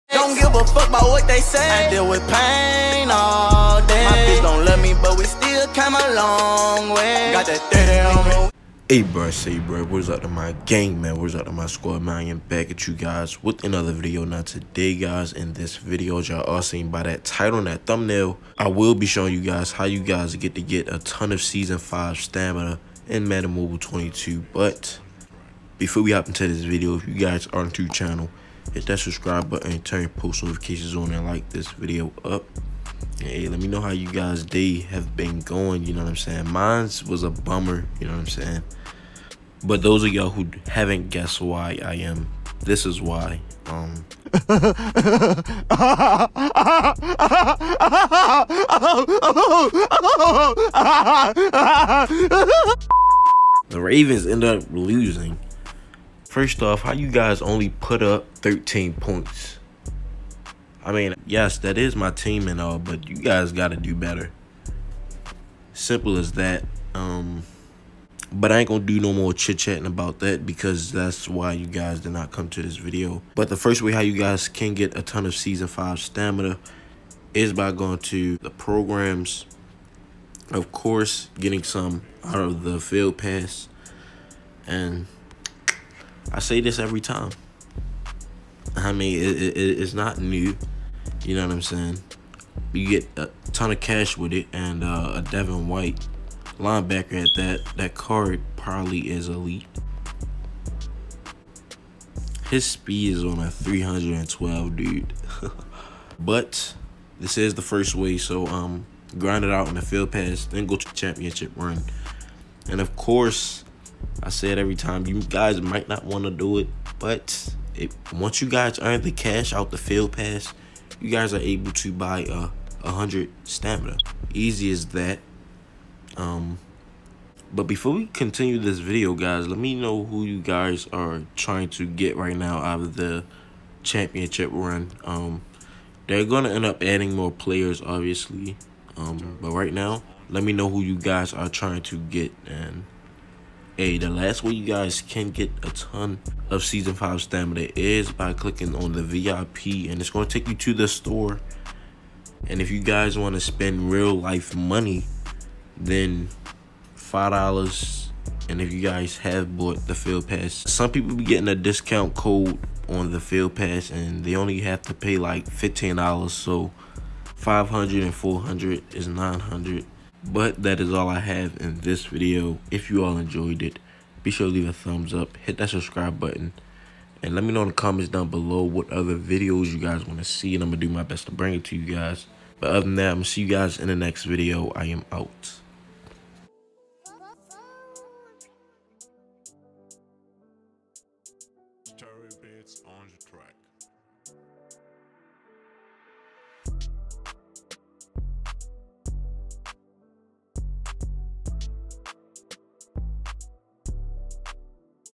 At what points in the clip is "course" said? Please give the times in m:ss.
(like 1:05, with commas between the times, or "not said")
1:20, 1:52.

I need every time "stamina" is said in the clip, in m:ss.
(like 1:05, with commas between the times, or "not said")
0:22, 1:15, 2:03, 2:27.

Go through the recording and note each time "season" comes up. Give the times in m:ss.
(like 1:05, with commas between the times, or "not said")
0:21, 1:15, 2:26.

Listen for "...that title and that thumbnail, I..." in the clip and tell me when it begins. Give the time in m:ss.
0:17.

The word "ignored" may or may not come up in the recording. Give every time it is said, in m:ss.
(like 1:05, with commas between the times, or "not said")
not said.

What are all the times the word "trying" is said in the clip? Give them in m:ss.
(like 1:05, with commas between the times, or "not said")
2:11, 2:21.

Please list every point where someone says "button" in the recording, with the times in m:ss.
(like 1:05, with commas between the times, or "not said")
0:29, 2:56.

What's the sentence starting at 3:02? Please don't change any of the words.
But other than that, I'm going to see you guys in the next video.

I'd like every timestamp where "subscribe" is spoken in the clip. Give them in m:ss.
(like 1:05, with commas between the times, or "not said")
0:28, 2:55.